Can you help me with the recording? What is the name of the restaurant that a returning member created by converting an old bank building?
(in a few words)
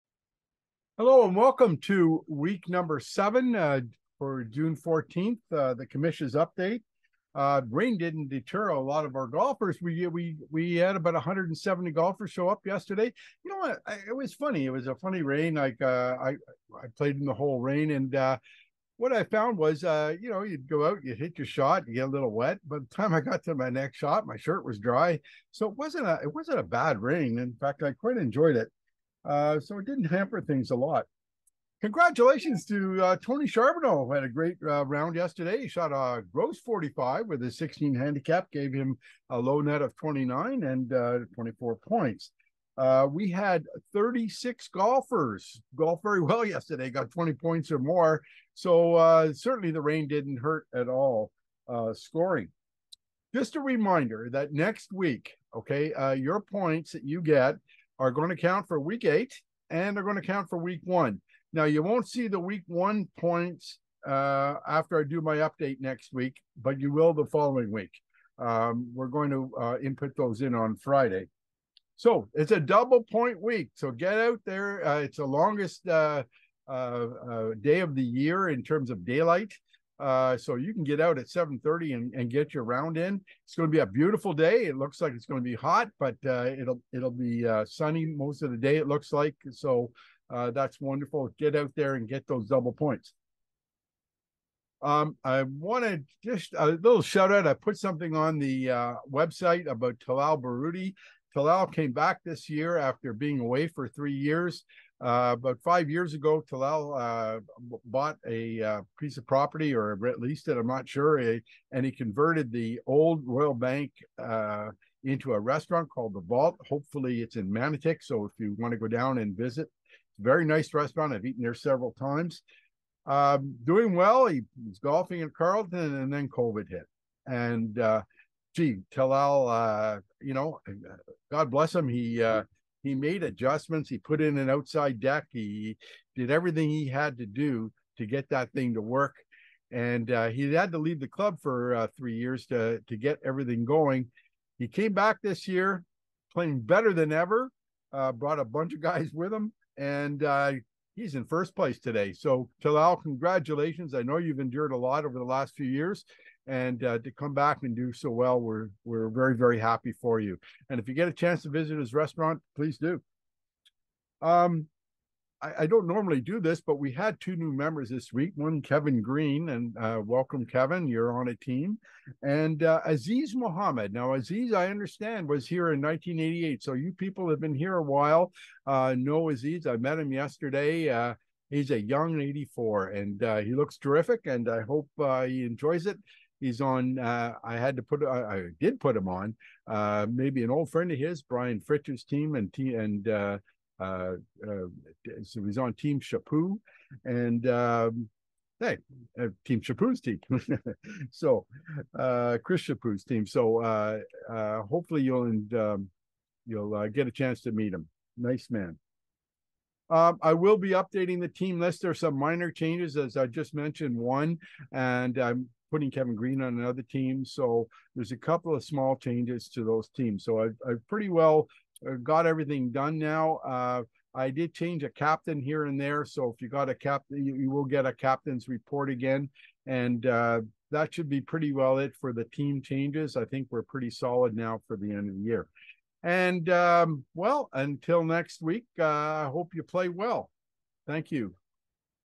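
The Vault.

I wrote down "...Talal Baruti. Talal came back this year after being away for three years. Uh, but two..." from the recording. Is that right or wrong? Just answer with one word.
wrong.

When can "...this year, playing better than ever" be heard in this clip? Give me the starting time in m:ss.
2:25.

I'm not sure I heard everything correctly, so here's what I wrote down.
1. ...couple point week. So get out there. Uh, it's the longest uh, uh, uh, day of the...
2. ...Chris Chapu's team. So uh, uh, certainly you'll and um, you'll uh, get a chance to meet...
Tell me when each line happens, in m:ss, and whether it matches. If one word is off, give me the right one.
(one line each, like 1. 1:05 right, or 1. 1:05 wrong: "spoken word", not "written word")
1. 1:12 wrong: "double", not "couple"
2. 3:22 wrong: "hopefully", not "certainly".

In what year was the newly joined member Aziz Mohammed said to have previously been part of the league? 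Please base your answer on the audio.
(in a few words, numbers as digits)
1988.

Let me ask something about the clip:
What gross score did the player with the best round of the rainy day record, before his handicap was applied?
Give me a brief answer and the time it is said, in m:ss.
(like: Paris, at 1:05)
45, at 0:36.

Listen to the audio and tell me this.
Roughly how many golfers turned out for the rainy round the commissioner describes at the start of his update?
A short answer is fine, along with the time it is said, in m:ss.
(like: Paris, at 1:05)
170, at 0:11.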